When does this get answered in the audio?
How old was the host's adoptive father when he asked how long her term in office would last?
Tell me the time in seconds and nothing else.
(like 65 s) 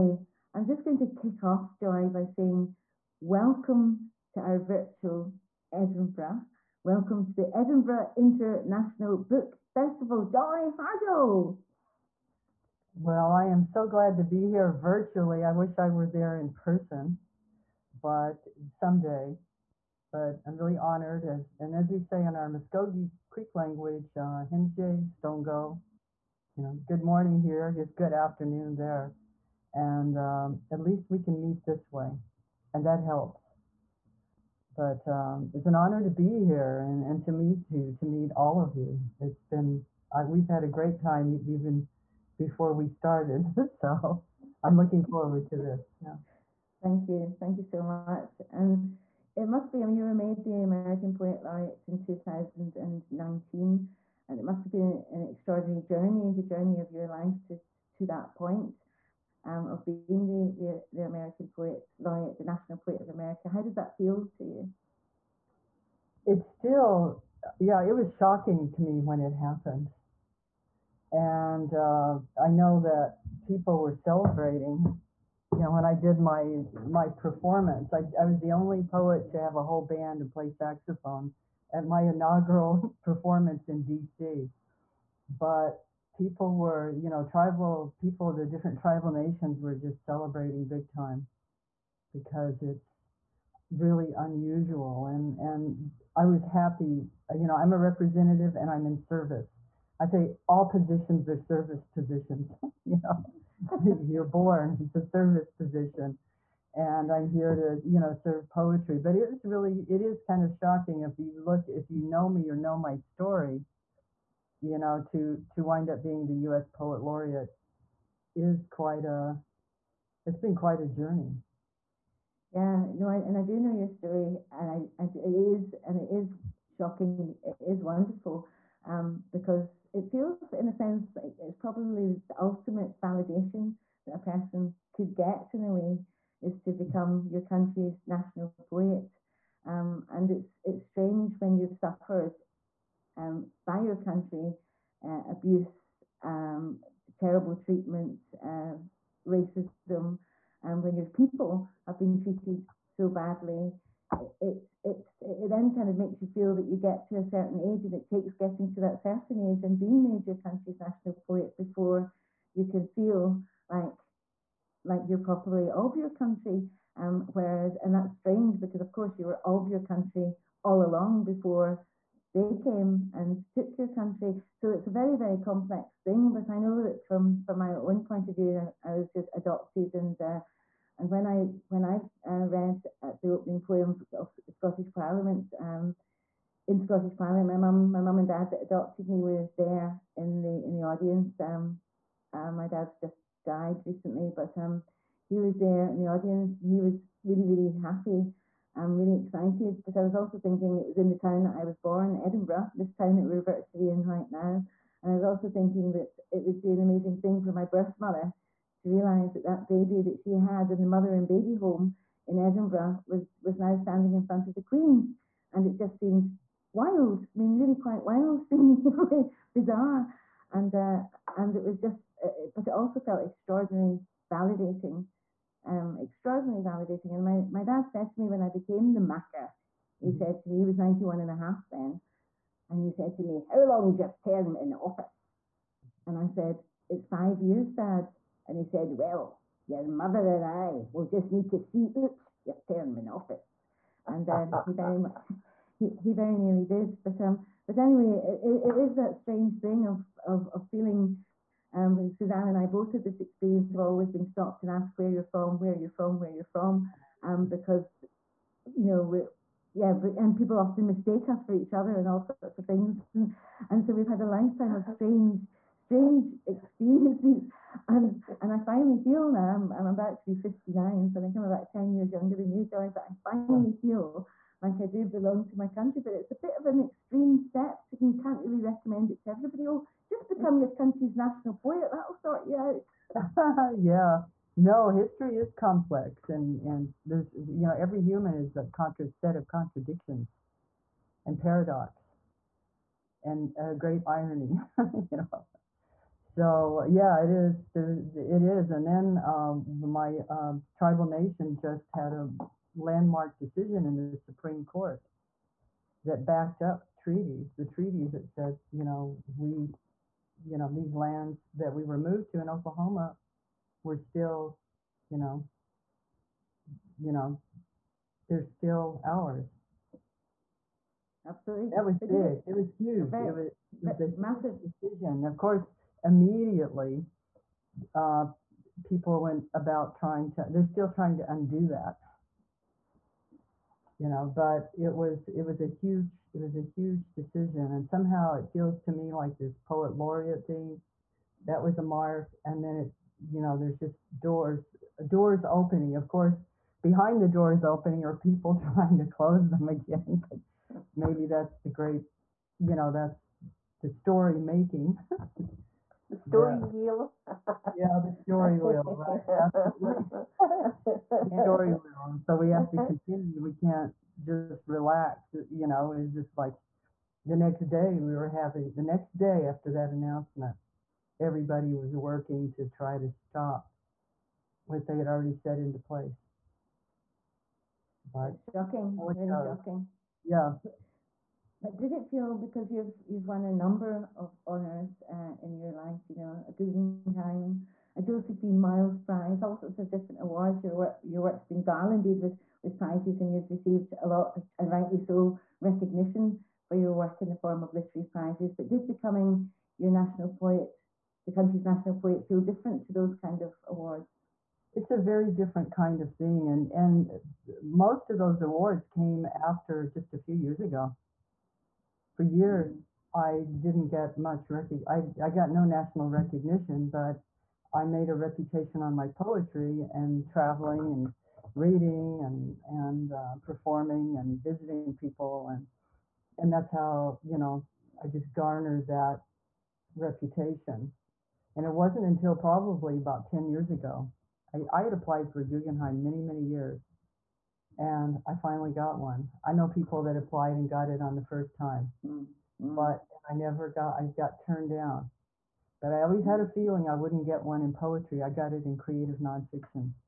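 230 s.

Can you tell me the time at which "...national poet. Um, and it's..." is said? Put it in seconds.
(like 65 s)
138 s.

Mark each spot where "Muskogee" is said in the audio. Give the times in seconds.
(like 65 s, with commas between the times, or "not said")
22 s.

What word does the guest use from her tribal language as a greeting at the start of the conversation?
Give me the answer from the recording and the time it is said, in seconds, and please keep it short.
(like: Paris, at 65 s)
Stongo, at 24 s.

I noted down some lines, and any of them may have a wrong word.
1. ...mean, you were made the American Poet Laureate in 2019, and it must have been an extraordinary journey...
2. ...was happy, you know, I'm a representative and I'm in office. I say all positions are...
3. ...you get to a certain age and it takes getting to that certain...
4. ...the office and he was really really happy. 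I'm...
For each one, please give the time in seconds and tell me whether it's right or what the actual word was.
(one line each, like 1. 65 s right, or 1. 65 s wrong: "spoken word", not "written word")
1. 49 s right
2. 96 s wrong: "service", not "office"
3. 156 s right
4. 195 s wrong: "audience", not "office".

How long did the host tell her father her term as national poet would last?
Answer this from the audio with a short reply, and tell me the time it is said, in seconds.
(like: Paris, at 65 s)
5 years, at 237 s.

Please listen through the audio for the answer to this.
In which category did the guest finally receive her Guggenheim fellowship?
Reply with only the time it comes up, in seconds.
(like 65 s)
448 s.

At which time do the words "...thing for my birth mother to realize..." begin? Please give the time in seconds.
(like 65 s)
207 s.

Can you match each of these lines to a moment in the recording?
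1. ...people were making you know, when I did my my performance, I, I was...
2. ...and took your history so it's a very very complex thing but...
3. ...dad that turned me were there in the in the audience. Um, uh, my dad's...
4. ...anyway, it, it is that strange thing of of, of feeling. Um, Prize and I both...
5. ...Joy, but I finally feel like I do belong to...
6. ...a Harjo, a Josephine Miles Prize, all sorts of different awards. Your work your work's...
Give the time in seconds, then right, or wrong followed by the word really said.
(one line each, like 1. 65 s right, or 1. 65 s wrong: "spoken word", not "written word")
1. 73 s wrong: "celebrating", not "making"
2. 173 s wrong: "country", not "history"
3. 188 s wrong: "adopted", not "turned"
4. 247 s wrong: "Suzanne", not "Prize"
5. 272 s right
6. 386 s wrong: "Guggenheim", not "Harjo".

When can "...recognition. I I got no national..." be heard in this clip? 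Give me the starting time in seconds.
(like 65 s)
414 s.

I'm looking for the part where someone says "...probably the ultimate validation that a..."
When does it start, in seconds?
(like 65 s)
131 s.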